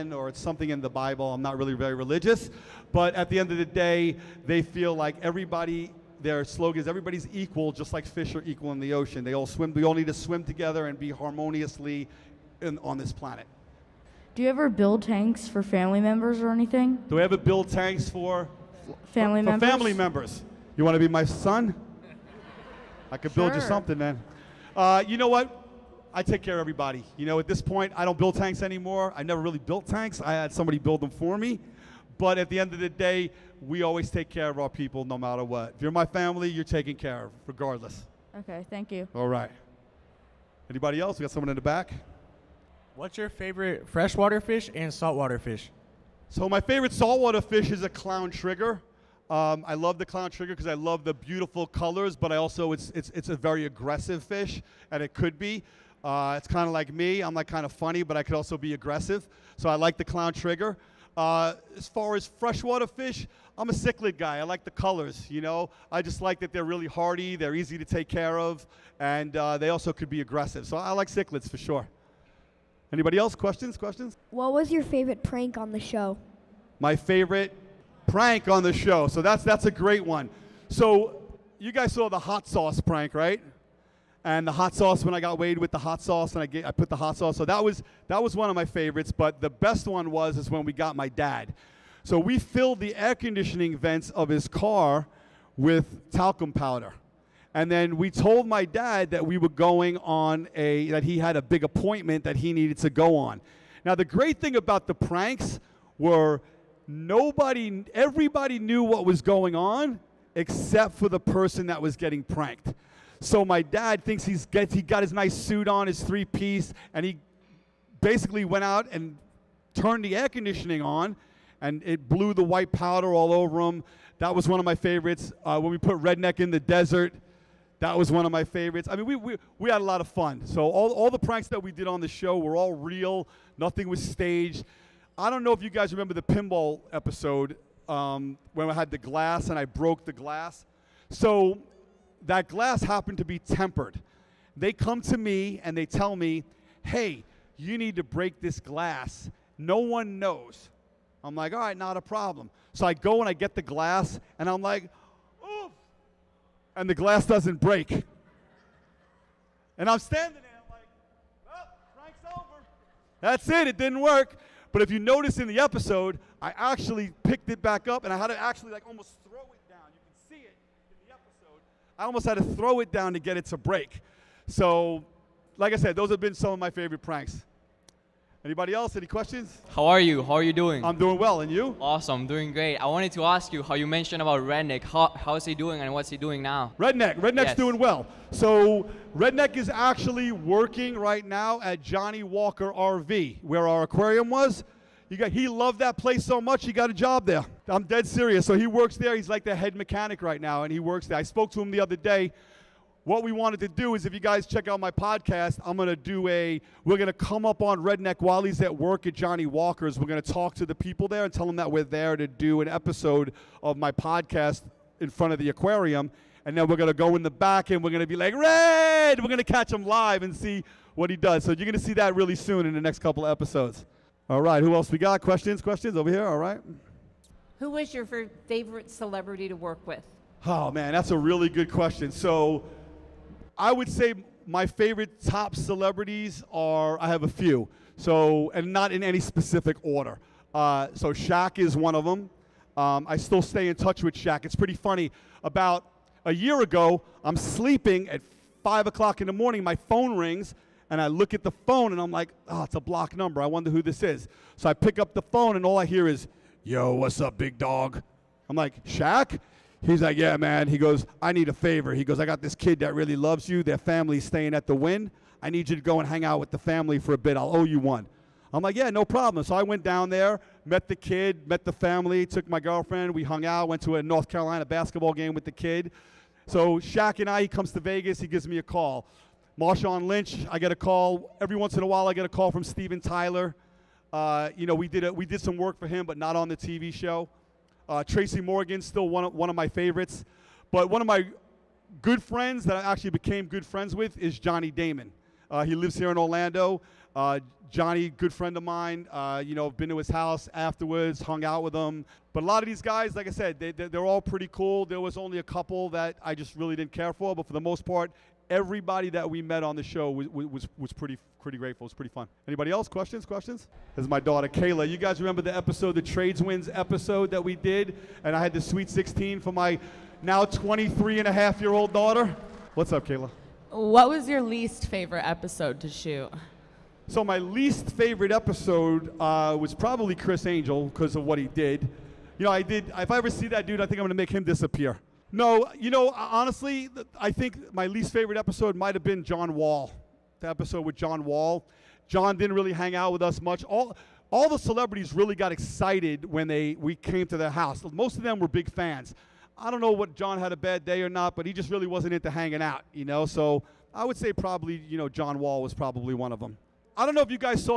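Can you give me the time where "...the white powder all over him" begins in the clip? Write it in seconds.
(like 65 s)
122 s.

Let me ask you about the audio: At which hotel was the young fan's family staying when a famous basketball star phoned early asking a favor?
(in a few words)
The Wynn.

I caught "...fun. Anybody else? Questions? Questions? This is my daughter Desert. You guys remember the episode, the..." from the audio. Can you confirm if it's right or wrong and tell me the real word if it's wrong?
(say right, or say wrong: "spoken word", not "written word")
wrong: "Kayla", not "Desert".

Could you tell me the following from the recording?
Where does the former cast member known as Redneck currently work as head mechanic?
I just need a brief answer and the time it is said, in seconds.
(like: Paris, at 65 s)
Johnny Walker RV, at 191 s.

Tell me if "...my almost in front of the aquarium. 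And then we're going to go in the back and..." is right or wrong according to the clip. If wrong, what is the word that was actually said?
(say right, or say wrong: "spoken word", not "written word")
wrong: "podcast", not "almost".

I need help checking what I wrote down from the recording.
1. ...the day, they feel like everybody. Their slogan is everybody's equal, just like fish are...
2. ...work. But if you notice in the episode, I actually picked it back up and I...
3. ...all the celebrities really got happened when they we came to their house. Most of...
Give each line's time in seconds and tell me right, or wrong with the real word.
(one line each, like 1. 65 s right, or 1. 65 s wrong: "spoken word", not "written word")
1. 3 s right
2. 163 s right
3. 344 s wrong: "excited", not "happened".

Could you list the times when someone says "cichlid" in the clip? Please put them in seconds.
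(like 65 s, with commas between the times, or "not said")
63 s, 71 s.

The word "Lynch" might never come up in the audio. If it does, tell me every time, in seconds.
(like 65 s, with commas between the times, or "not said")
280 s.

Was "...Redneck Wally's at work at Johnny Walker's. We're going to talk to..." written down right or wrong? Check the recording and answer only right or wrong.
right.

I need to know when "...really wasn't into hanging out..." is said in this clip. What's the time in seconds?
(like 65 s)
351 s.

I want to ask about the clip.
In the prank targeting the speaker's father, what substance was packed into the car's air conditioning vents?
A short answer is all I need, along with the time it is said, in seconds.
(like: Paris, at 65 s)
Talcum powder, at 96 s.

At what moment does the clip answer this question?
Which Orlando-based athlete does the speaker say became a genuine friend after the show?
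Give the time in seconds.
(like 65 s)
294 s.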